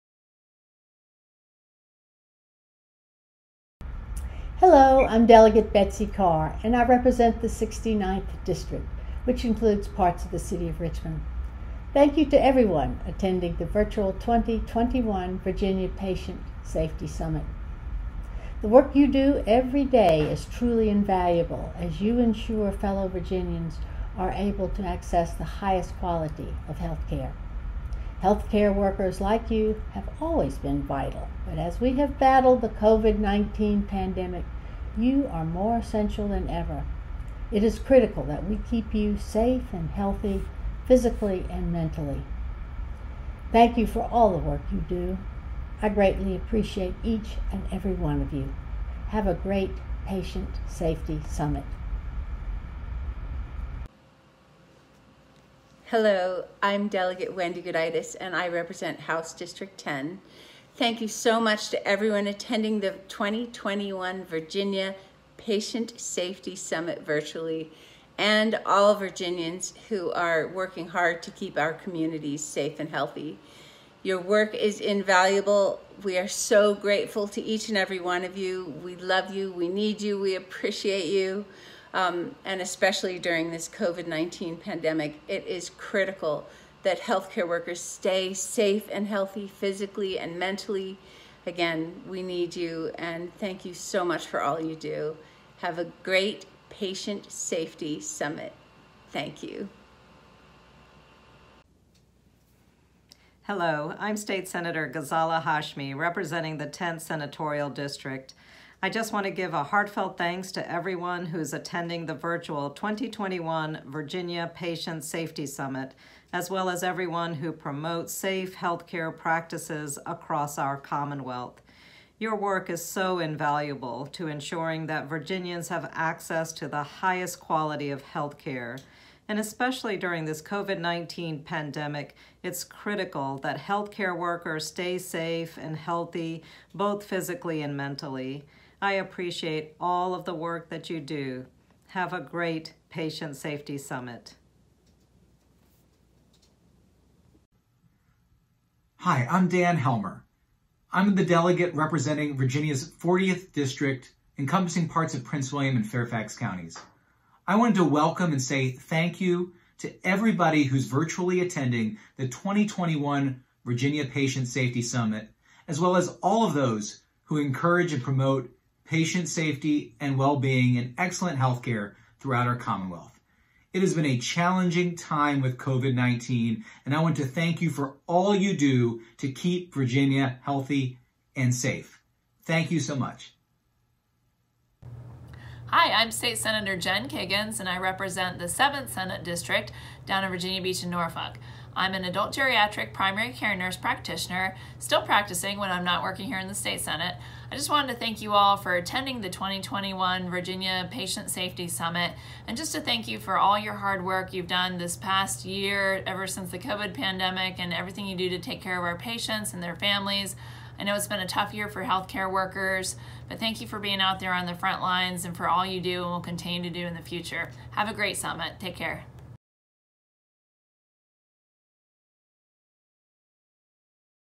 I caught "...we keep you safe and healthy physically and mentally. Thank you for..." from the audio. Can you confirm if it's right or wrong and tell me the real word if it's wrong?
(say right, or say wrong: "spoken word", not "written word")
right.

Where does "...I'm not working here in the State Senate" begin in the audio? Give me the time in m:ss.
3:15.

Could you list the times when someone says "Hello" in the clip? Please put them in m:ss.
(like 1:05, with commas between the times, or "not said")
0:04, 0:55, 1:43.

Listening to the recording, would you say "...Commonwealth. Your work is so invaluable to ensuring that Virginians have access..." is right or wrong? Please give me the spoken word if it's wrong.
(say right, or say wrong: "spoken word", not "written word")
right.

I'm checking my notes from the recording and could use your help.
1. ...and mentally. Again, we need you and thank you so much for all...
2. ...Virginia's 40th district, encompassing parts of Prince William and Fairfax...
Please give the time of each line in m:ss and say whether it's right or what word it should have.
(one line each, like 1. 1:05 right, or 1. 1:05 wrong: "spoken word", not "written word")
1. 1:30 right
2. 2:32 right.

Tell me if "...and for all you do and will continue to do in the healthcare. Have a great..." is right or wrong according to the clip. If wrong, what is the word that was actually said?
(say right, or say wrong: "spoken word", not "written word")
wrong: "future", not "healthcare".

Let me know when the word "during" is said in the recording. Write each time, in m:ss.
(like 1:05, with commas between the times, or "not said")
1:23, 2:09.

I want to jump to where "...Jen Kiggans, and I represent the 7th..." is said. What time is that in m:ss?
3:06.